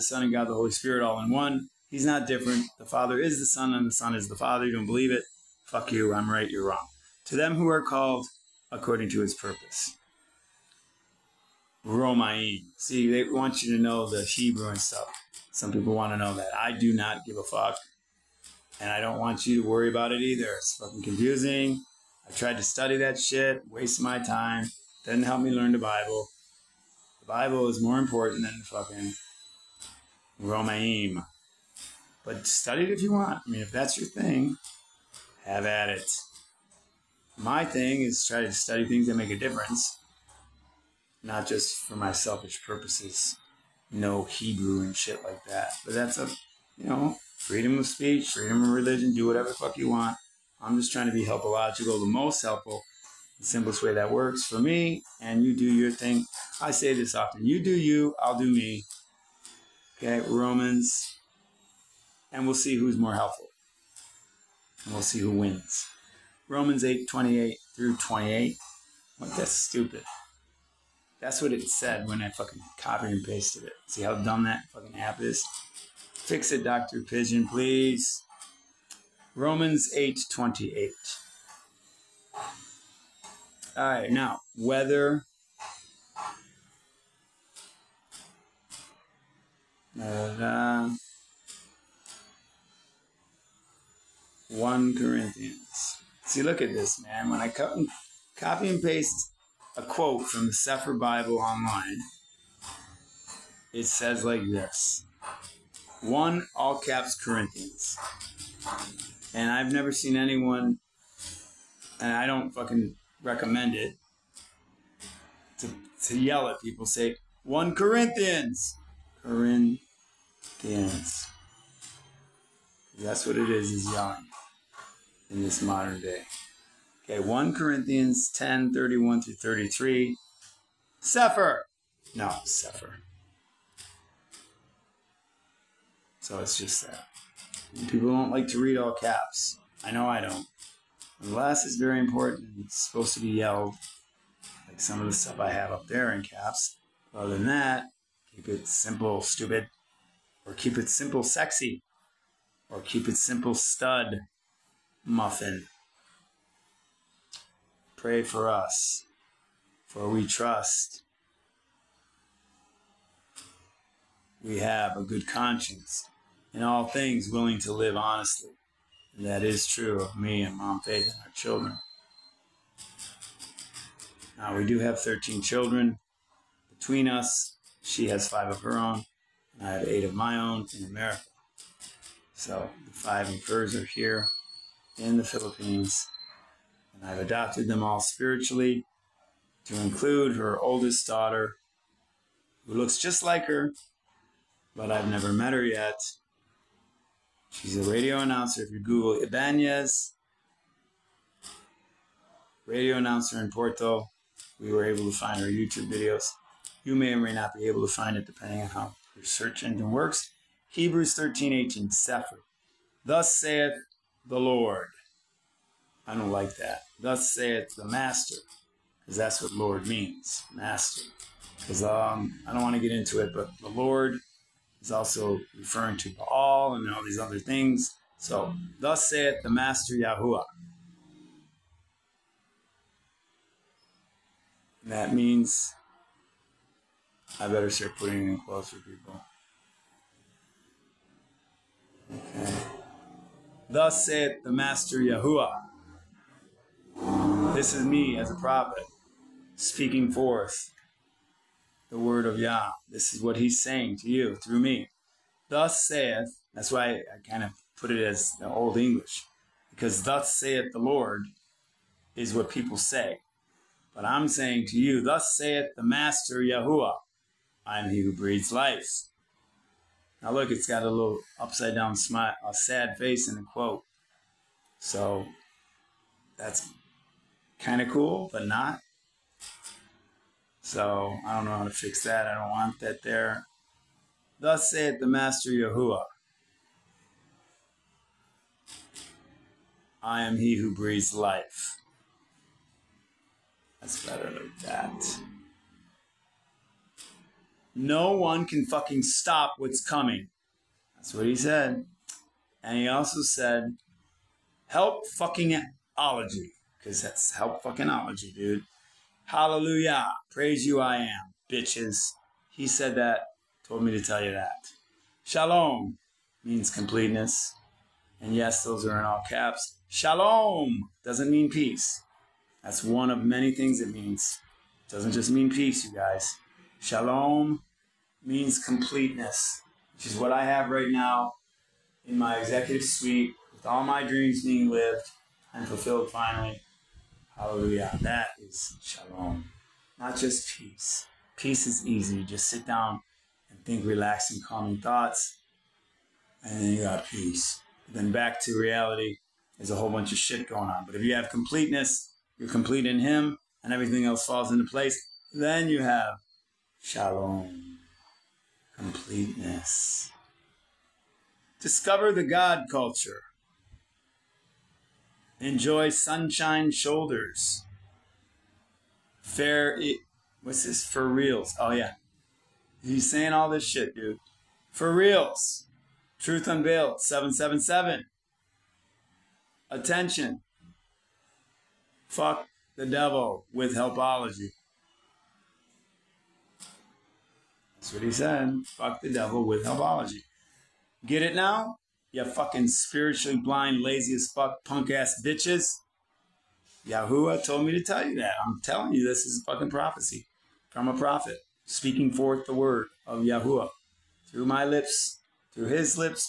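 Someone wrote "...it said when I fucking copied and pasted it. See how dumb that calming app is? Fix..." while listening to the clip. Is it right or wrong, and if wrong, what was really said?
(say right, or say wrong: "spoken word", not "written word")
wrong: "fucking", not "calming".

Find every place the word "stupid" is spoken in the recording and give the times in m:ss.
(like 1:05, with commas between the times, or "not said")
1:09, 2:29.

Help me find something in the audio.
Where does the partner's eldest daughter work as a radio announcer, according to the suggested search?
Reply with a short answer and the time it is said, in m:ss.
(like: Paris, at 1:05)
Porto, at 3:23.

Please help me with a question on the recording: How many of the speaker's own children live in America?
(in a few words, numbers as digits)
8.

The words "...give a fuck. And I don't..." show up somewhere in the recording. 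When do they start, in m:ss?
0:17.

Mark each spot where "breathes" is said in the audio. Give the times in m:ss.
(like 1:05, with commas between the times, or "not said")
4:28, 4:50.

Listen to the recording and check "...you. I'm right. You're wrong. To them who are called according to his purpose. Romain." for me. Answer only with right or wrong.
right.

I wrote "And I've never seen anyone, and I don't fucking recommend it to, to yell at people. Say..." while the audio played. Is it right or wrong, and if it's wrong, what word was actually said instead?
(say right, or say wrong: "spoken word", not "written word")
right.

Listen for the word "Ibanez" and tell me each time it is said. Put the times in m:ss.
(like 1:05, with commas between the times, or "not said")
3:19.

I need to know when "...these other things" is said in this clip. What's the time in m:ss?
3:47.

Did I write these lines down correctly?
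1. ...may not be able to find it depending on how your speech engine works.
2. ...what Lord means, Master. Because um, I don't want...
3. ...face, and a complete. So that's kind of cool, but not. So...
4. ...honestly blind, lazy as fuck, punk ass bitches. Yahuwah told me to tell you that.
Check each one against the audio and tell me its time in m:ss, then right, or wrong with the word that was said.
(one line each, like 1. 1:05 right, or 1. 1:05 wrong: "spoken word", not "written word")
1. 3:27 wrong: "search", not "speech"
2. 3:39 right
3. 4:32 wrong: "quote", not "complete"
4. 6:32 wrong: "spiritually", not "honestly".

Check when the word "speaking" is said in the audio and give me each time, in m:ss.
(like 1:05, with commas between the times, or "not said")
4:09, 6:41.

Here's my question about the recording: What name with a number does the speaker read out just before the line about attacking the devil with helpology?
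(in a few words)
Truth Unveiled 777.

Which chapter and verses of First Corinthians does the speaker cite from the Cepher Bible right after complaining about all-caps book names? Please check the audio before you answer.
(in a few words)
10:31-33.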